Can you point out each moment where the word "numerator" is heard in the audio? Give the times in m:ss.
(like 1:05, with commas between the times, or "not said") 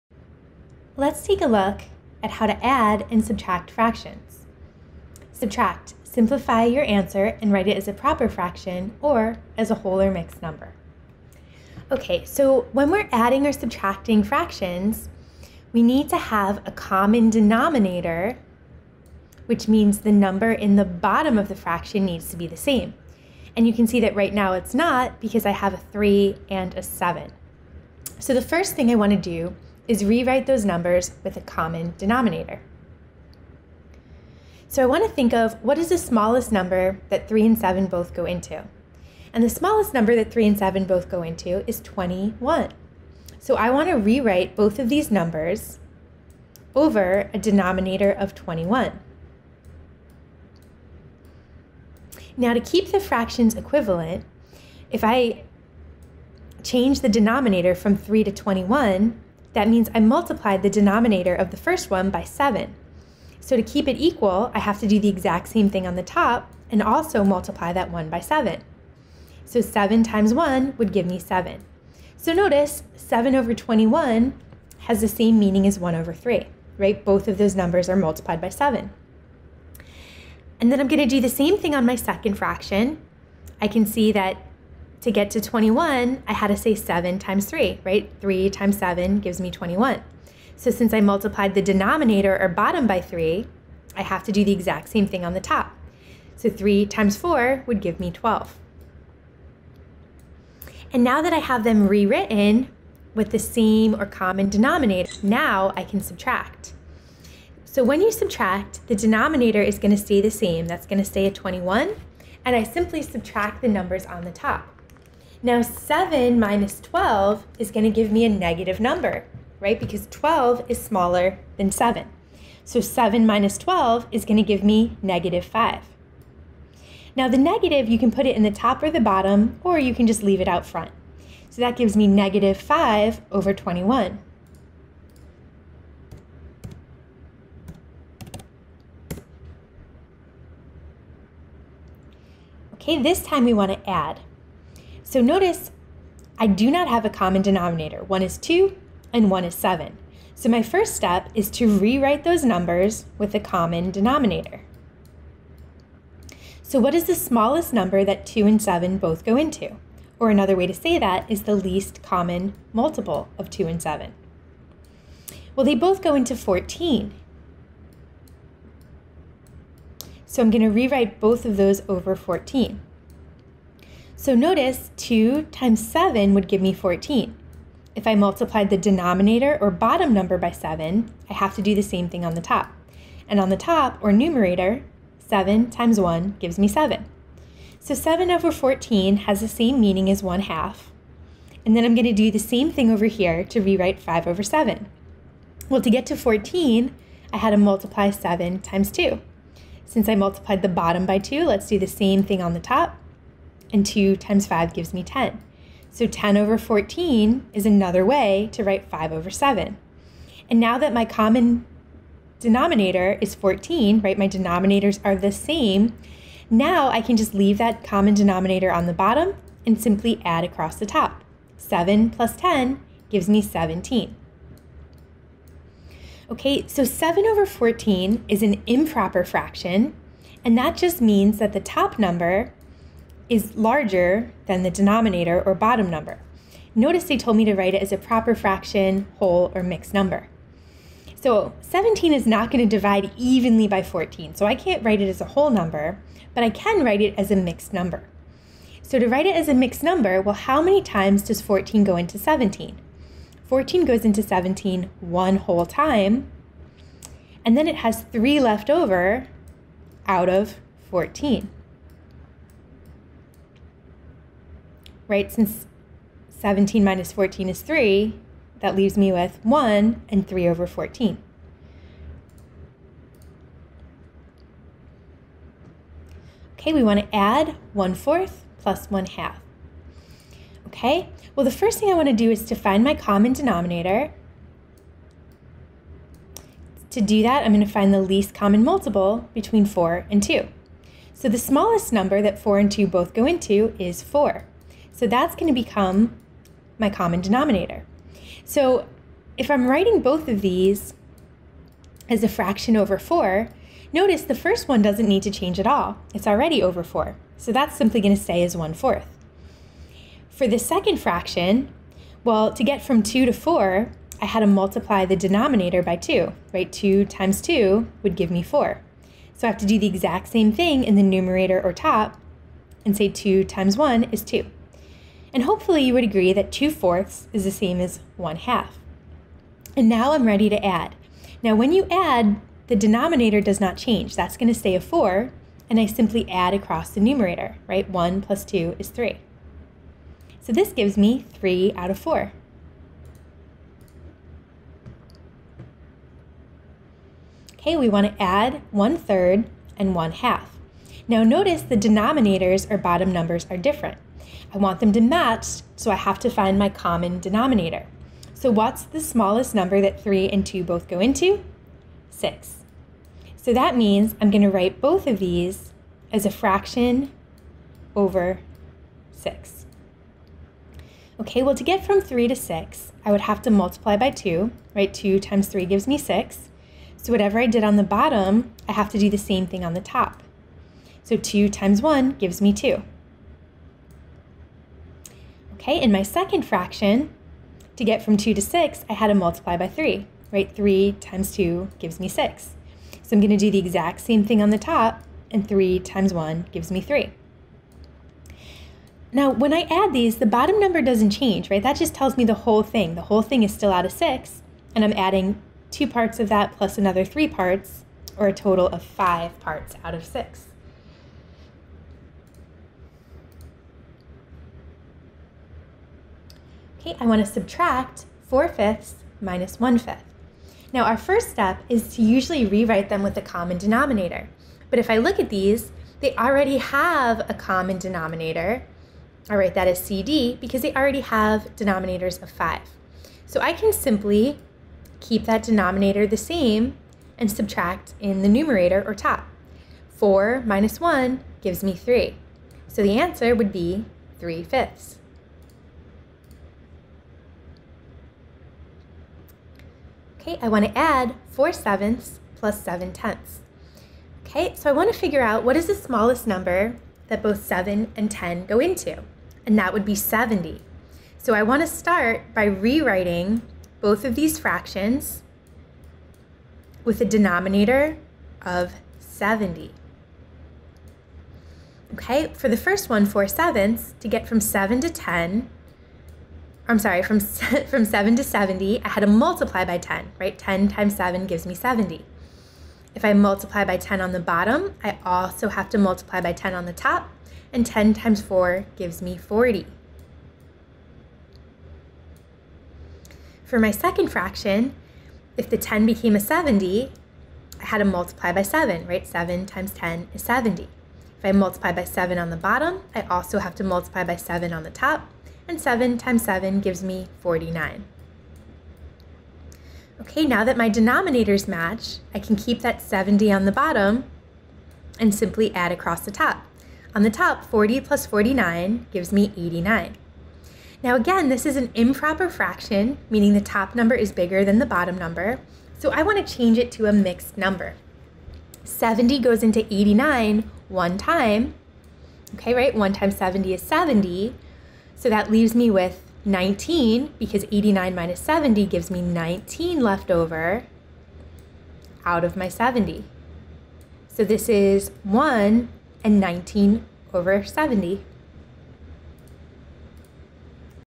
3:04, 5:21, 5:36, 7:18.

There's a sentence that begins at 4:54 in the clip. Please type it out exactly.
So that's going to become my common denominator.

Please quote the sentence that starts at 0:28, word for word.
So the first thing I want to do is rewrite those numbers with a common denominator.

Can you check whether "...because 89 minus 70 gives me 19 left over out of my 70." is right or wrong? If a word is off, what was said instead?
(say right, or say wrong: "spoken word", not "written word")
right.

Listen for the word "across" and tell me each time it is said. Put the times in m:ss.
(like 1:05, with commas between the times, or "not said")
3:40, 5:36, 8:35.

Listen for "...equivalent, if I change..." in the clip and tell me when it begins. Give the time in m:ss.
0:53.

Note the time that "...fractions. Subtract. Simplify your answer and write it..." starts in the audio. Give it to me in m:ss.
0:03.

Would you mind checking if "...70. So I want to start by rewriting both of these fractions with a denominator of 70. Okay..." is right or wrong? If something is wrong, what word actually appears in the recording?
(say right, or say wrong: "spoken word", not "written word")
right.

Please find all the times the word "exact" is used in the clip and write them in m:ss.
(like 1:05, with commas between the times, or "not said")
1:05, 1:34, 5:19, 6:33.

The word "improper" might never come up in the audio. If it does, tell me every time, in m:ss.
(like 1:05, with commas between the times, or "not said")
3:48, 8:41.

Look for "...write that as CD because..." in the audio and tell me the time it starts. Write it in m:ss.
7:09.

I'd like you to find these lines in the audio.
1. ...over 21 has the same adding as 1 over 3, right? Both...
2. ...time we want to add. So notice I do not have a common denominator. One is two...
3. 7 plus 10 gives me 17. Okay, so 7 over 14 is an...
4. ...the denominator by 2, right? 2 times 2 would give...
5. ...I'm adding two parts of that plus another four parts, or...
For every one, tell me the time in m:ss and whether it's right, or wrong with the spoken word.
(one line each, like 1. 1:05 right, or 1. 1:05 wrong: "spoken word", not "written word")
1. 1:13 wrong: "meaning", not "adding"
2. 2:23 right
3. 3:41 right
4. 5:15 right
5. 6:44 wrong: "three", not "four".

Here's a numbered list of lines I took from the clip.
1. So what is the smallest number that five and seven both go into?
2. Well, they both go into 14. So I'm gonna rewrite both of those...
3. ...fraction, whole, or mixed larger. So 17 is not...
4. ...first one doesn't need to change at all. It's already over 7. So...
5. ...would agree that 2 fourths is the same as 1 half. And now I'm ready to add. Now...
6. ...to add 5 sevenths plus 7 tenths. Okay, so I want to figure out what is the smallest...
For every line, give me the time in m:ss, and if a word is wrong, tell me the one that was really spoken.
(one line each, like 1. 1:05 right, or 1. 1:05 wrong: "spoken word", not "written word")
1. 2:36 wrong: "two", not "five"
2. 2:45 right
3. 3:58 wrong: "number", not "larger"
4. 5:04 wrong: "4", not "7"
5. 5:25 right
6. 7:30 wrong: "4", not "5".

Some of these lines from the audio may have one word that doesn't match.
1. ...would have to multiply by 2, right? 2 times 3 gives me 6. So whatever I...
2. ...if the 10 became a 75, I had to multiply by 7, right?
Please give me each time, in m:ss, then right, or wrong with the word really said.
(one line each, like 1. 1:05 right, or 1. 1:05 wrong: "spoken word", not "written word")
1. 6:13 right
2. 8:15 wrong: "70", not "75".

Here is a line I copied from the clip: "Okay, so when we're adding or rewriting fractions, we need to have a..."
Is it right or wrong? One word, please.
wrong.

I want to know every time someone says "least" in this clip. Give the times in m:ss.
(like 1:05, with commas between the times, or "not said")
2:41, 4:48.